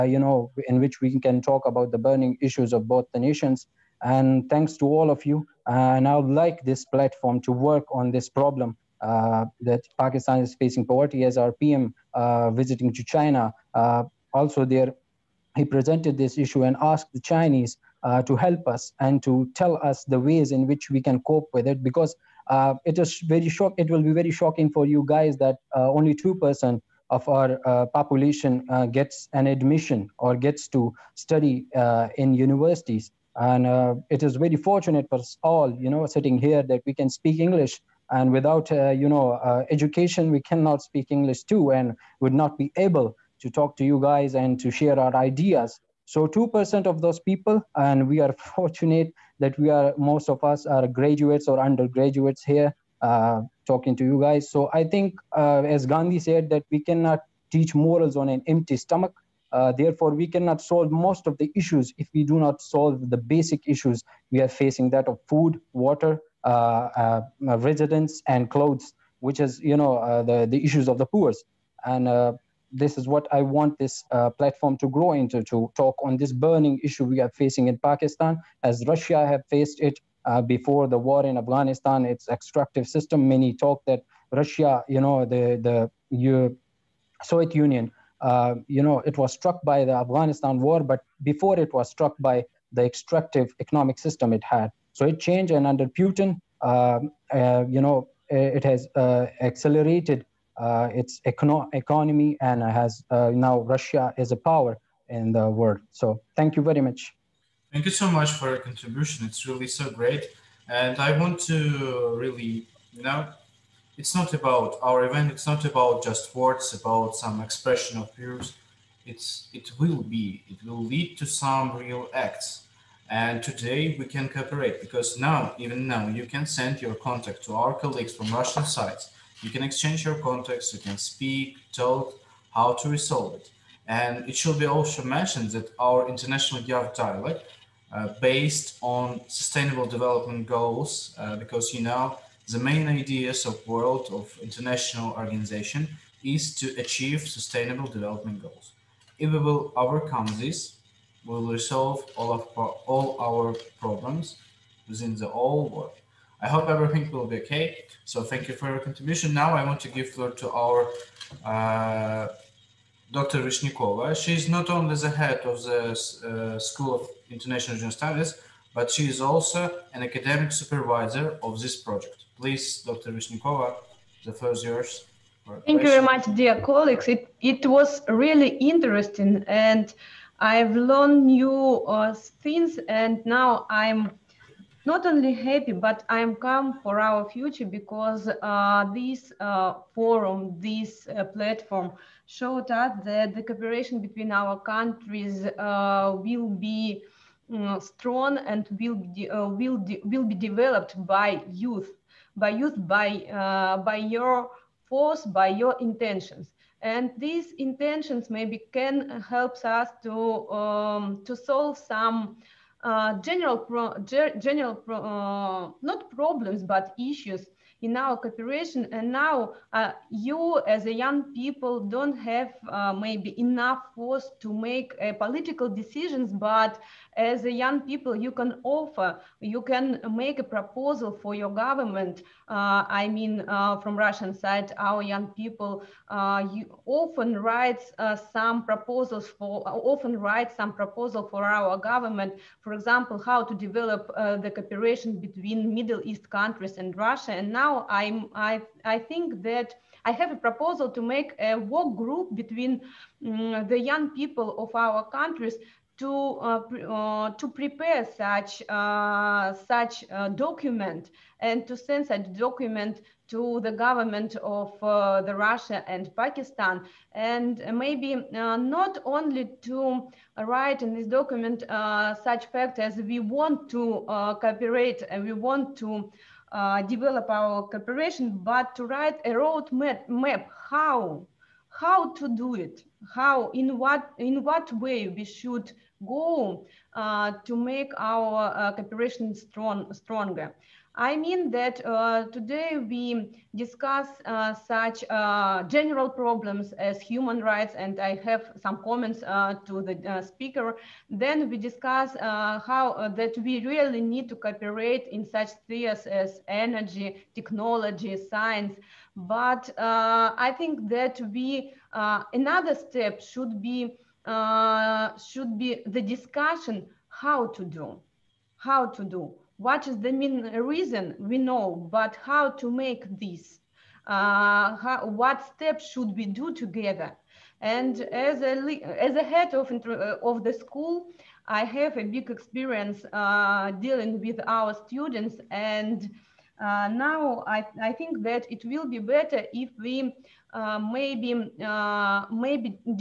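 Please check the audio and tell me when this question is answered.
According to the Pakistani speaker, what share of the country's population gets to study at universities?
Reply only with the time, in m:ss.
0:26.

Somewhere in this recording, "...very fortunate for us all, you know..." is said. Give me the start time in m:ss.
0:34.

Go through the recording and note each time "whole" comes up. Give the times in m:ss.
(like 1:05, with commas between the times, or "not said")
2:35.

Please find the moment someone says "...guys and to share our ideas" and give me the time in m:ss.
0:43.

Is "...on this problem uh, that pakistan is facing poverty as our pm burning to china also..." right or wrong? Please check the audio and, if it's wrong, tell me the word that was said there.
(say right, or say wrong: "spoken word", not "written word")
wrong: "visiting", not "burning".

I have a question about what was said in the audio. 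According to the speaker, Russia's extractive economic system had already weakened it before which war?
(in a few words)
the war in Afghanistan.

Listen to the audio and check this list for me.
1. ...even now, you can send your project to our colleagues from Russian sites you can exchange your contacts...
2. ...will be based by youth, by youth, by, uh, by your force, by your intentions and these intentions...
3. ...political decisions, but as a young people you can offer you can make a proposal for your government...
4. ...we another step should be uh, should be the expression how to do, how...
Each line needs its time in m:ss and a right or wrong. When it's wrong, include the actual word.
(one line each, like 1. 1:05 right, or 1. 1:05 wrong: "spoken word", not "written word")
1. 2:05 wrong: "contact", not "project"
2. 3:20 wrong: "developed", not "based"
3. 3:45 right
4. 5:11 wrong: "discussion", not "expression".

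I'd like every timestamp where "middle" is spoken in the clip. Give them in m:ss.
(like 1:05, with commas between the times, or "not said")
4:05.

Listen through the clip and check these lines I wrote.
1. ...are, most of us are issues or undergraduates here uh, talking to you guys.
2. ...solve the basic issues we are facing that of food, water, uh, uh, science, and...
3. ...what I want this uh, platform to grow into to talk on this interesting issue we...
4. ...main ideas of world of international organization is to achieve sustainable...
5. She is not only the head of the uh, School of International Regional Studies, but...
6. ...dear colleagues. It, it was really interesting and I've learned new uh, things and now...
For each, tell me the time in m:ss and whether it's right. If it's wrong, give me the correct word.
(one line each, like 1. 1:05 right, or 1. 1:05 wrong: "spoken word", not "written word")
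1. 0:49 wrong: "graduates", not "issues"
2. 1:02 wrong: "residence", not "science"
3. 1:13 wrong: "burning", not "interesting"
4. 2:22 right
5. 2:44 right
6. 2:56 right.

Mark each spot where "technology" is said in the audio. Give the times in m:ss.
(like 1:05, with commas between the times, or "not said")
5:07.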